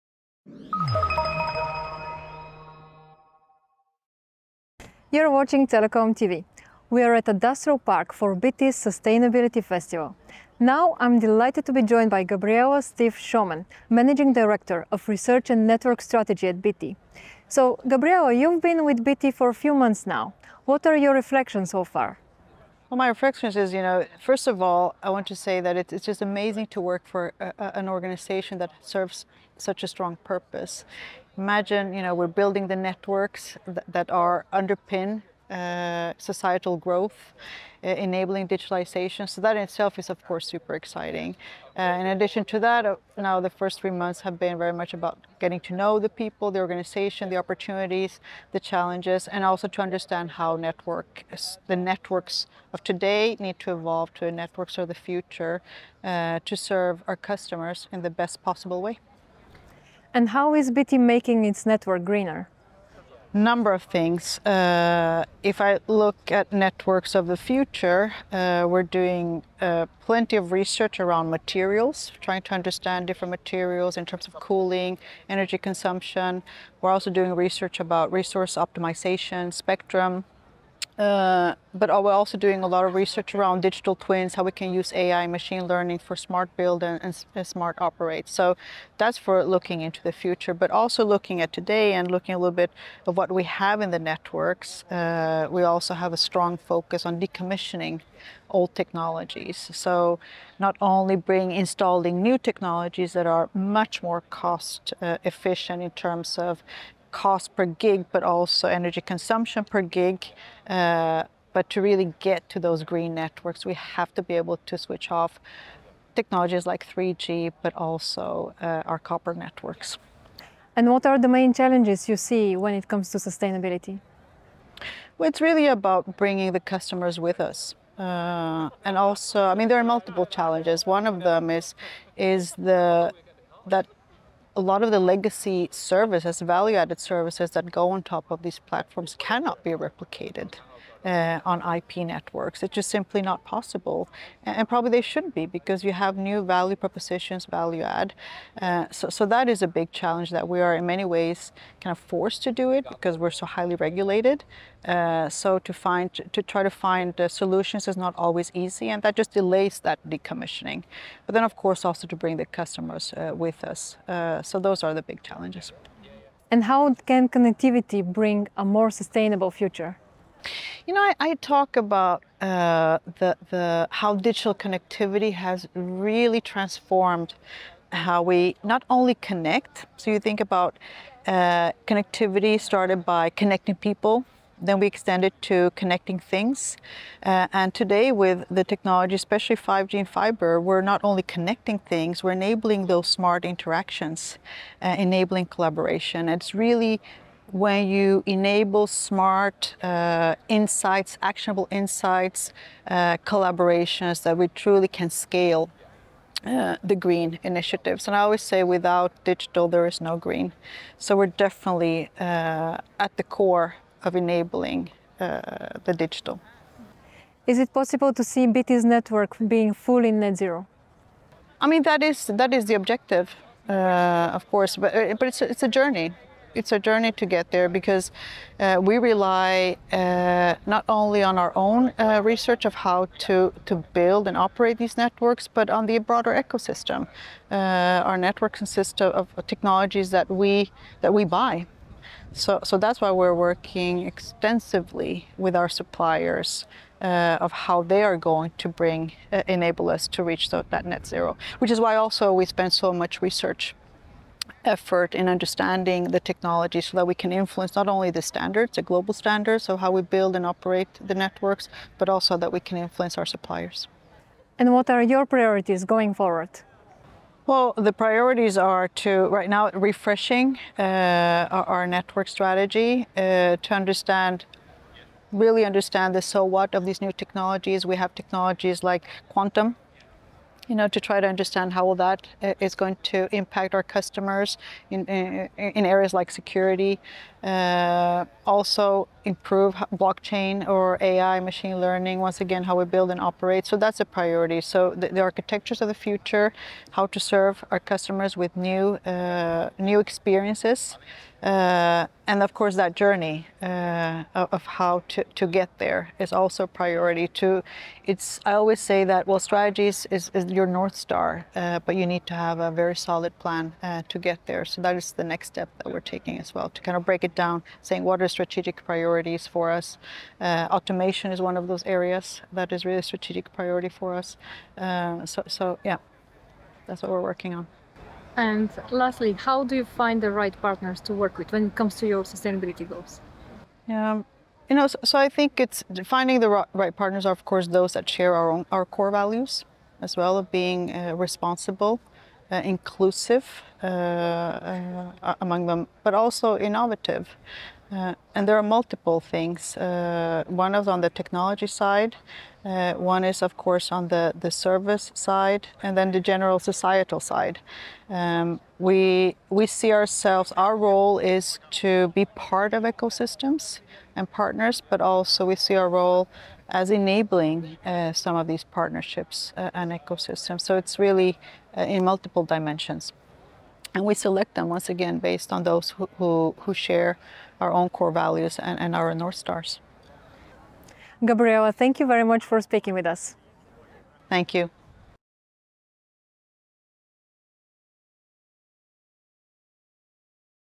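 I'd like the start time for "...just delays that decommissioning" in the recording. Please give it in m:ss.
2:39.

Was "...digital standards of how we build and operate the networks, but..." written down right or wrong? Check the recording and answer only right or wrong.
wrong.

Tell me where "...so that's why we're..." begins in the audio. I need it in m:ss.
4:02.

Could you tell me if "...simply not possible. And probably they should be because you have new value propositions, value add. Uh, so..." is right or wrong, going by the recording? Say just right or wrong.
right.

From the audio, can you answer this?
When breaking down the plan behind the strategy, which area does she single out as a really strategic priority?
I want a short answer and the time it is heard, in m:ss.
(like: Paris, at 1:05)
Automation, at 5:20.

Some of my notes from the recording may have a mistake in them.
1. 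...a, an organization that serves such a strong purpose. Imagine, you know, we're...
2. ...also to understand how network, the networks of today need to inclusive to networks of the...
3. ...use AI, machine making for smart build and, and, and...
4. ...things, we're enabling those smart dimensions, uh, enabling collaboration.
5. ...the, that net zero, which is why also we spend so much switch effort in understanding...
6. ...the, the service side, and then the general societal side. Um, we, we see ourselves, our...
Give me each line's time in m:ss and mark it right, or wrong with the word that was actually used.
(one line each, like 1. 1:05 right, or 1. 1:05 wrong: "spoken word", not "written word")
1. 0:27 right
2. 0:49 wrong: "evolve", not "inclusive"
3. 1:24 wrong: "learning", not "making"
4. 3:11 wrong: "interactions", not "dimensions"
5. 4:10 wrong: "research", not "switch"
6. 5:54 right.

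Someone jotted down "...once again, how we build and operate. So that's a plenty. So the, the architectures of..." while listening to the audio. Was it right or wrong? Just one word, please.
wrong.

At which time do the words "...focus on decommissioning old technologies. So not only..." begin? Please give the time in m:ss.
1:36.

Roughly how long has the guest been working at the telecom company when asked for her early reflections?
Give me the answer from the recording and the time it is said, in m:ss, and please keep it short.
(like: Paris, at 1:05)
3 months, at 0:43.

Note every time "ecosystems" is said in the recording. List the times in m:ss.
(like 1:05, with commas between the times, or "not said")
3:56, 6:02, 6:09.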